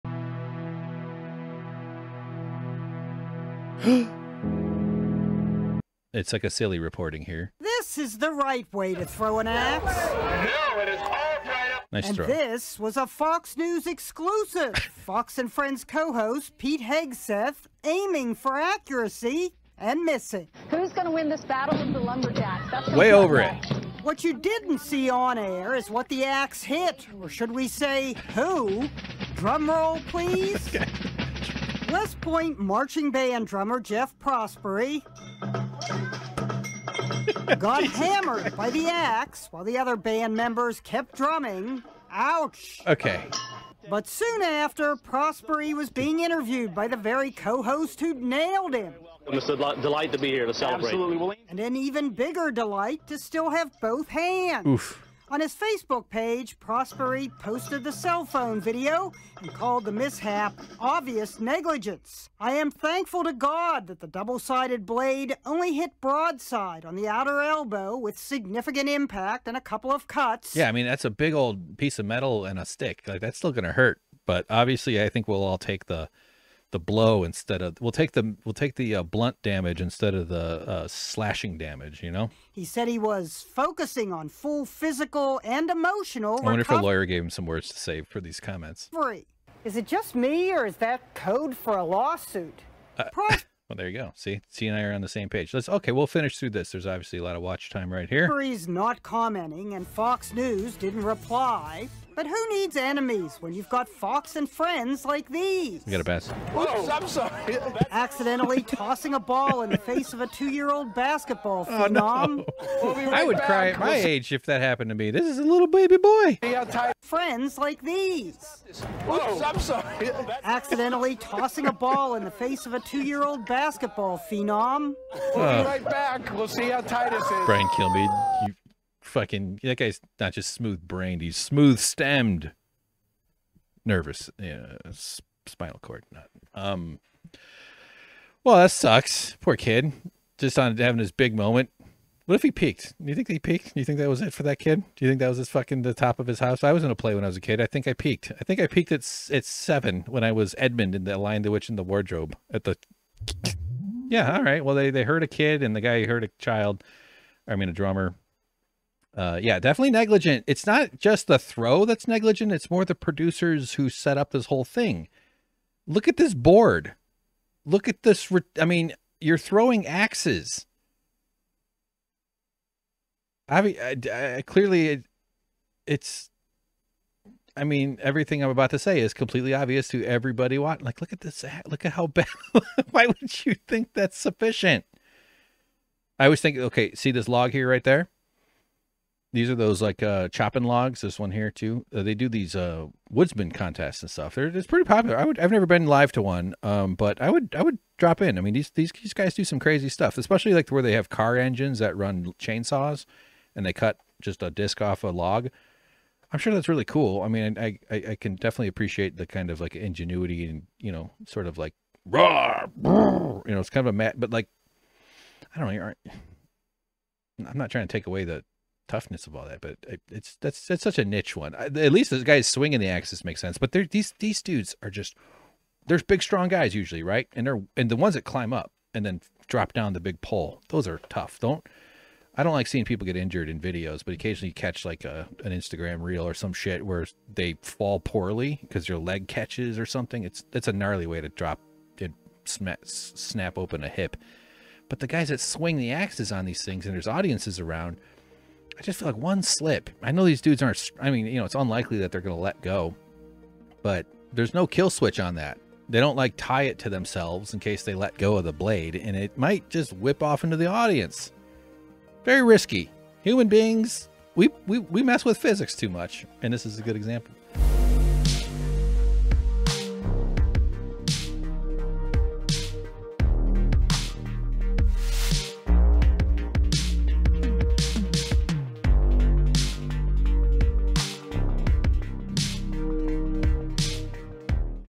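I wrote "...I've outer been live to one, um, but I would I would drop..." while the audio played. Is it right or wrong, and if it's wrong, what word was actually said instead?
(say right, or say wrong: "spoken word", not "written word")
wrong: "never", not "outer".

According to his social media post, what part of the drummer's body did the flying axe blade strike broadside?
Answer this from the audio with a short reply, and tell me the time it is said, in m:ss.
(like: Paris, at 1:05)
outer elbow, at 1:07.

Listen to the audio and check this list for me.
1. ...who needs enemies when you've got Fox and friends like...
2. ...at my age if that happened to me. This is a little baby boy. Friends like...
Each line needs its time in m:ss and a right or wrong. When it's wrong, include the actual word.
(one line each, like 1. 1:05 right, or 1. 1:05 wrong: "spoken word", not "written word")
1. 1:42 right
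2. 1:53 right.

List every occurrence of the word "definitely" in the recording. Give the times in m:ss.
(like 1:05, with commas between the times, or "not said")
2:39, 3:28.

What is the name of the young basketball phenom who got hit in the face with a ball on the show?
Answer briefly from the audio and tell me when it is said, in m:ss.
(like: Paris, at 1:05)
Titus, at 2:06.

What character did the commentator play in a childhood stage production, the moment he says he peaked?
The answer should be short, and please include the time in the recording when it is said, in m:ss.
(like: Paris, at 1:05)
Edmund, at 2:30.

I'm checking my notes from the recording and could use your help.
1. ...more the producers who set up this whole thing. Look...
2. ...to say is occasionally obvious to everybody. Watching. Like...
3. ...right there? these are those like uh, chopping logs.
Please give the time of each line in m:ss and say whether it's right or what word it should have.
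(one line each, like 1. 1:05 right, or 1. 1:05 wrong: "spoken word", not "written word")
1. 2:42 right
2. 2:58 wrong: "completely", not "occasionally"
3. 3:07 right.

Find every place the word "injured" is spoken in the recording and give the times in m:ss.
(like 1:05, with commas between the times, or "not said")
3:53.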